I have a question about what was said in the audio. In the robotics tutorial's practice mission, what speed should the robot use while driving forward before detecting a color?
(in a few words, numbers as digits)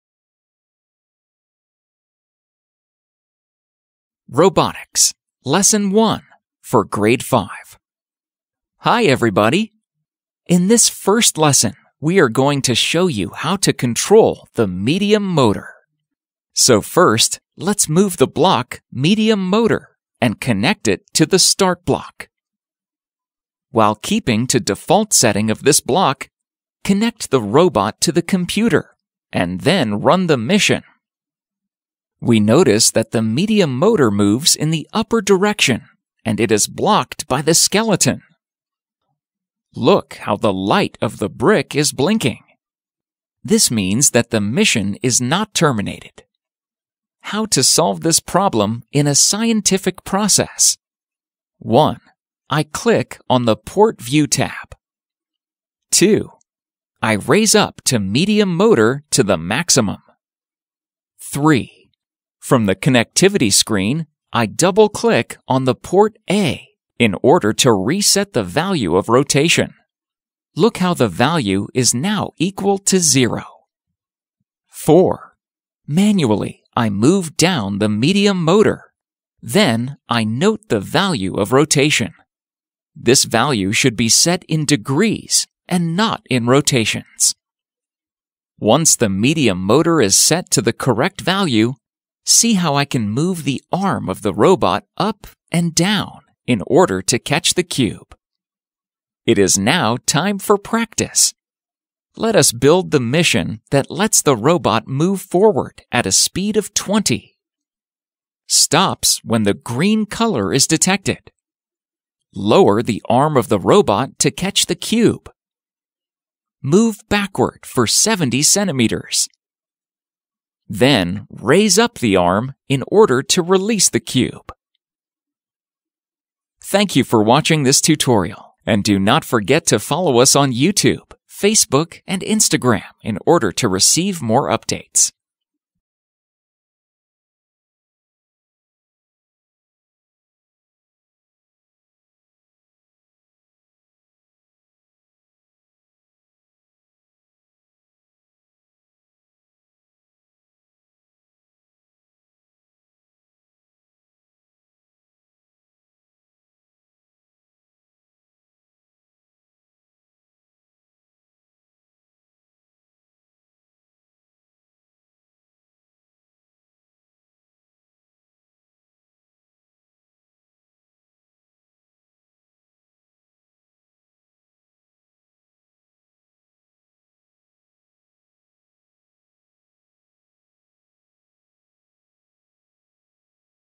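20.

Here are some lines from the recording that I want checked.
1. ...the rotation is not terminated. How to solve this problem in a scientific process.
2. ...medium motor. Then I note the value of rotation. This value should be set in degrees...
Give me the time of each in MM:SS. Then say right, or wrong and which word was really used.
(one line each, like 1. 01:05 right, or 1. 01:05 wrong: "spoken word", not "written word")
1. 00:44 wrong: "mission", not "rotation"
2. 01:17 right.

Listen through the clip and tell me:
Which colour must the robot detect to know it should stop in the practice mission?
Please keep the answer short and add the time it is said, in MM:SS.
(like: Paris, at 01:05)
green, at 01:49.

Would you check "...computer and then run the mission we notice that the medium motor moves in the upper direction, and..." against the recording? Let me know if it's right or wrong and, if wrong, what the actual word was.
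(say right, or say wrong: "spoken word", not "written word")
right.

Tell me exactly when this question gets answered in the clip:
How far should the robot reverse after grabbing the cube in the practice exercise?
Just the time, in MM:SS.
01:57.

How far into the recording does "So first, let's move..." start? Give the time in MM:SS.
00:16.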